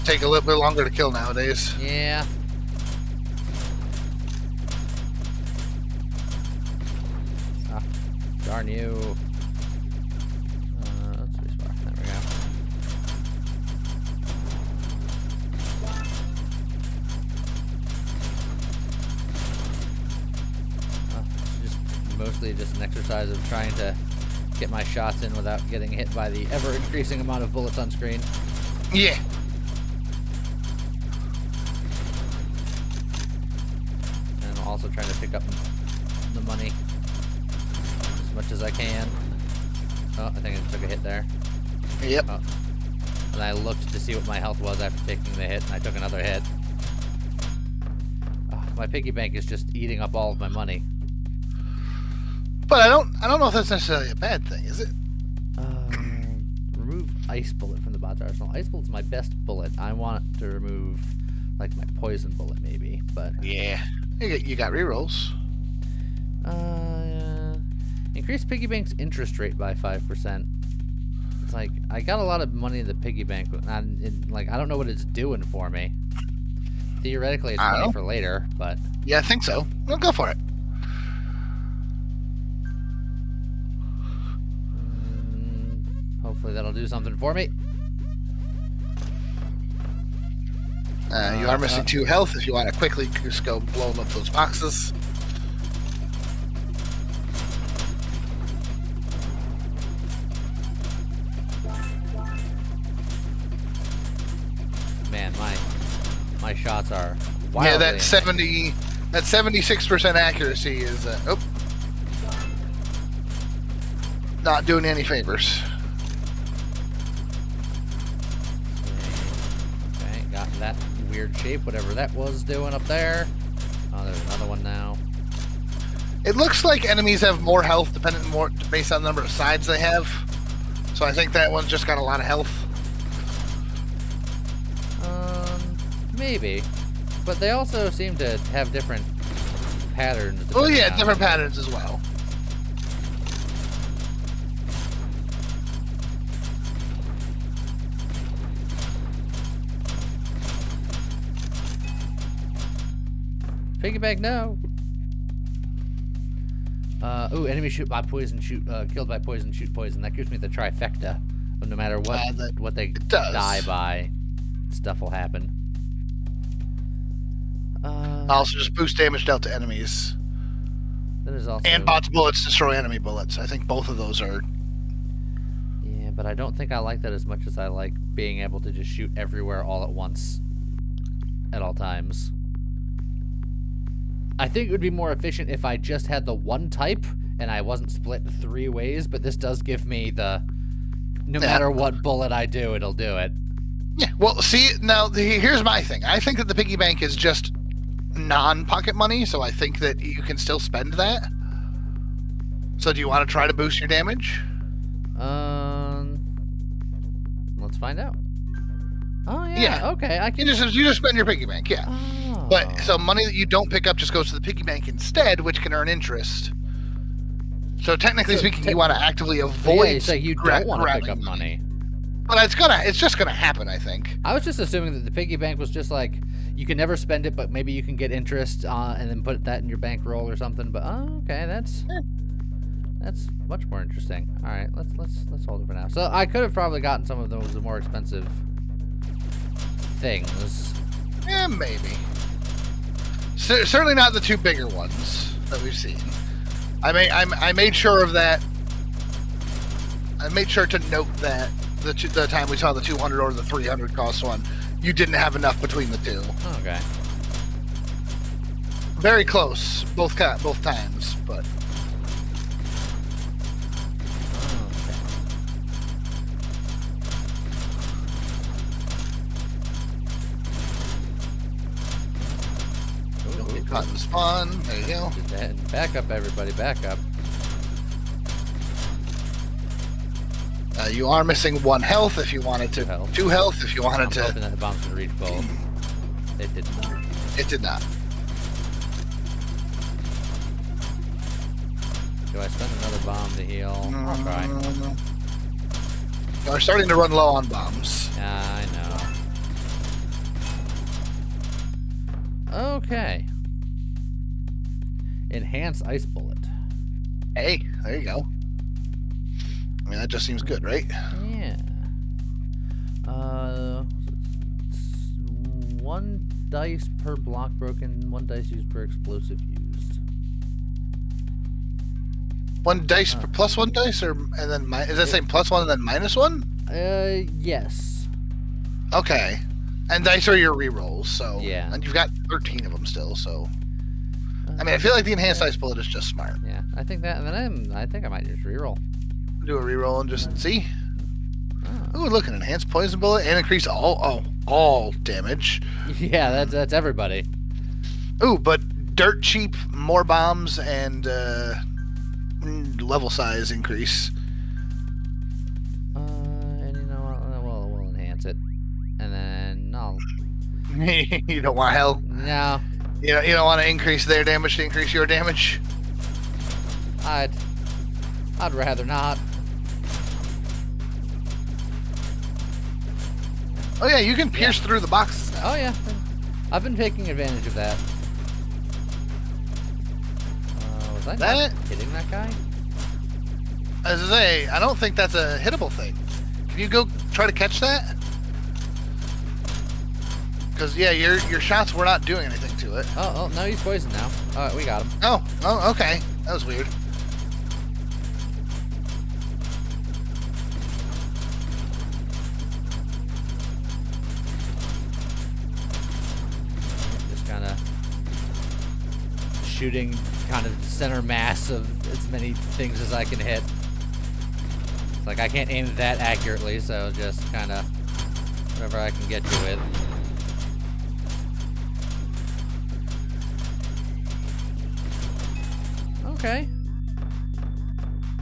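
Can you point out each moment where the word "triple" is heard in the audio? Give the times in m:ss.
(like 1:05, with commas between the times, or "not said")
not said.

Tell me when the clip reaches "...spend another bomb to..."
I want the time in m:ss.
4:52.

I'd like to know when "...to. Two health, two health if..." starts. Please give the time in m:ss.
4:42.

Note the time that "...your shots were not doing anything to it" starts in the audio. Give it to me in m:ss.
6:31.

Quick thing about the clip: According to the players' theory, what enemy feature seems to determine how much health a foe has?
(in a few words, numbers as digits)
number of sides.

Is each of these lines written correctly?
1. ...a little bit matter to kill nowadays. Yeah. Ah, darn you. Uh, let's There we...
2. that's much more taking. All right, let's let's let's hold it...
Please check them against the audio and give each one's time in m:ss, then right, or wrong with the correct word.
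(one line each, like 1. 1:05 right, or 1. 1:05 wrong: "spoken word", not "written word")
1. 0:00 wrong: "longer", not "matter"
2. 3:53 wrong: "interesting", not "taking".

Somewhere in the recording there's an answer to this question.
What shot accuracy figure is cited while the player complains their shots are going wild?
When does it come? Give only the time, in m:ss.
1:49.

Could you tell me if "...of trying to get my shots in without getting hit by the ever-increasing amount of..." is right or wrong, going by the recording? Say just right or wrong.
right.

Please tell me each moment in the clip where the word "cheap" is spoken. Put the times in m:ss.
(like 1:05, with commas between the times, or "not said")
5:49.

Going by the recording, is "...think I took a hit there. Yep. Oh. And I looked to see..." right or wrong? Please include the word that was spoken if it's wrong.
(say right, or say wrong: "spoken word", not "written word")
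right.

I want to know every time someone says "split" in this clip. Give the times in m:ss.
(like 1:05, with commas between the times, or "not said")
3:07.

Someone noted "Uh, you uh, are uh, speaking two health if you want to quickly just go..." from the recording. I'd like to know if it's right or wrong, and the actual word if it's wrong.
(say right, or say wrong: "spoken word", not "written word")
wrong: "missing", not "speaking".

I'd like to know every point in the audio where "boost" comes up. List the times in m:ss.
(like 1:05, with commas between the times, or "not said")
2:48, 3:23.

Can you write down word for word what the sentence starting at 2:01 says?
weird shape, whatever that was doing up there.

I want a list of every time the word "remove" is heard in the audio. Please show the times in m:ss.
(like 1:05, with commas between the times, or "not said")
1:00.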